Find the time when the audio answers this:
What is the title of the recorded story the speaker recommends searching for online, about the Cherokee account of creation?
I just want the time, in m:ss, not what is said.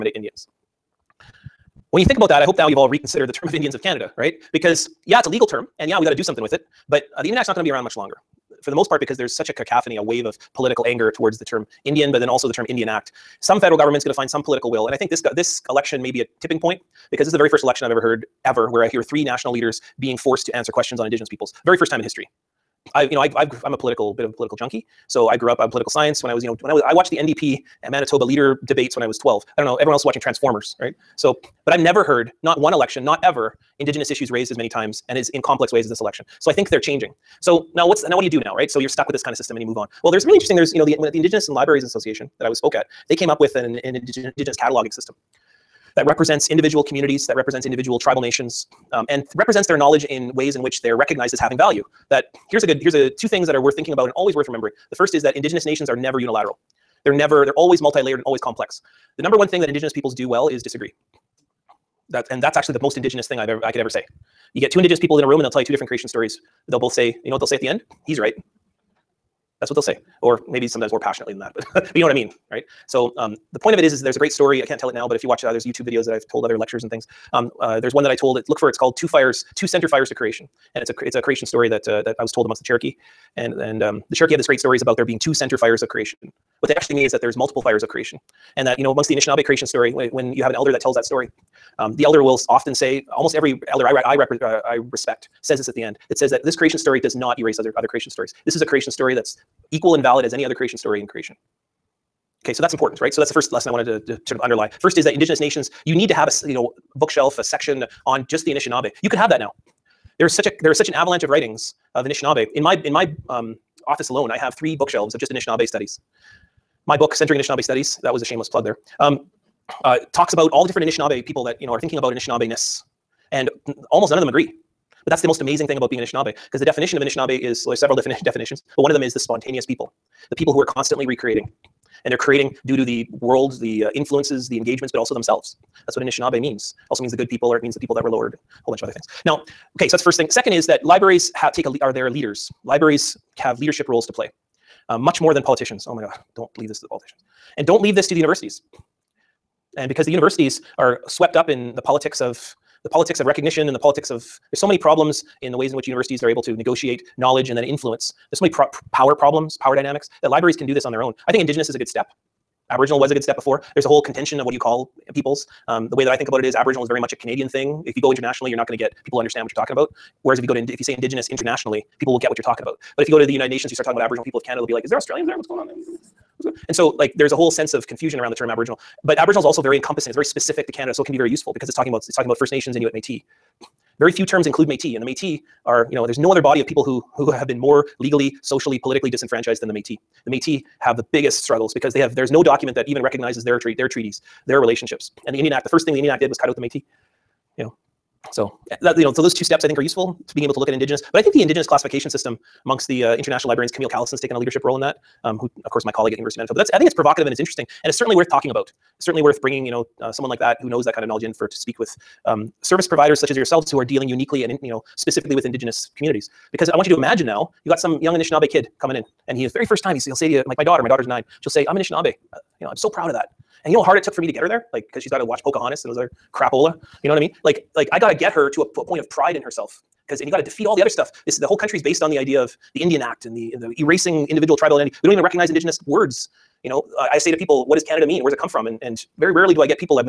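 1:18.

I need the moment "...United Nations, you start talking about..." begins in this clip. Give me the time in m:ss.
2:53.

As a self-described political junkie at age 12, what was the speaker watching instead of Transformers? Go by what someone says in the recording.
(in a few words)
NDP and Manitoba leader debates.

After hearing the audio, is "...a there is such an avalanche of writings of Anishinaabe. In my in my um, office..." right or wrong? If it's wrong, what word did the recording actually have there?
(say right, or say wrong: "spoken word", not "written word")
right.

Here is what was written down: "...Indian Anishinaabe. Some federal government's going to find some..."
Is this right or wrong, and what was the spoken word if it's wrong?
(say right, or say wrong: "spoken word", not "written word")
wrong: "Act", not "Anishinaabe".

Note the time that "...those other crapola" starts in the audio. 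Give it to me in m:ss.
3:45.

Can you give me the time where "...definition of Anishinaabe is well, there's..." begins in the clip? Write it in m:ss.
2:06.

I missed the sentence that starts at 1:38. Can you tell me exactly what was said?
This is a creation story that's equal and valid as any other creation story in creation.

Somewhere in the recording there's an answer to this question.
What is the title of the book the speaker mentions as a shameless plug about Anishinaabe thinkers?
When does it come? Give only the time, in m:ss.
1:57.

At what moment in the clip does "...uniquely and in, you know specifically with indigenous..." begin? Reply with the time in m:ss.
3:34.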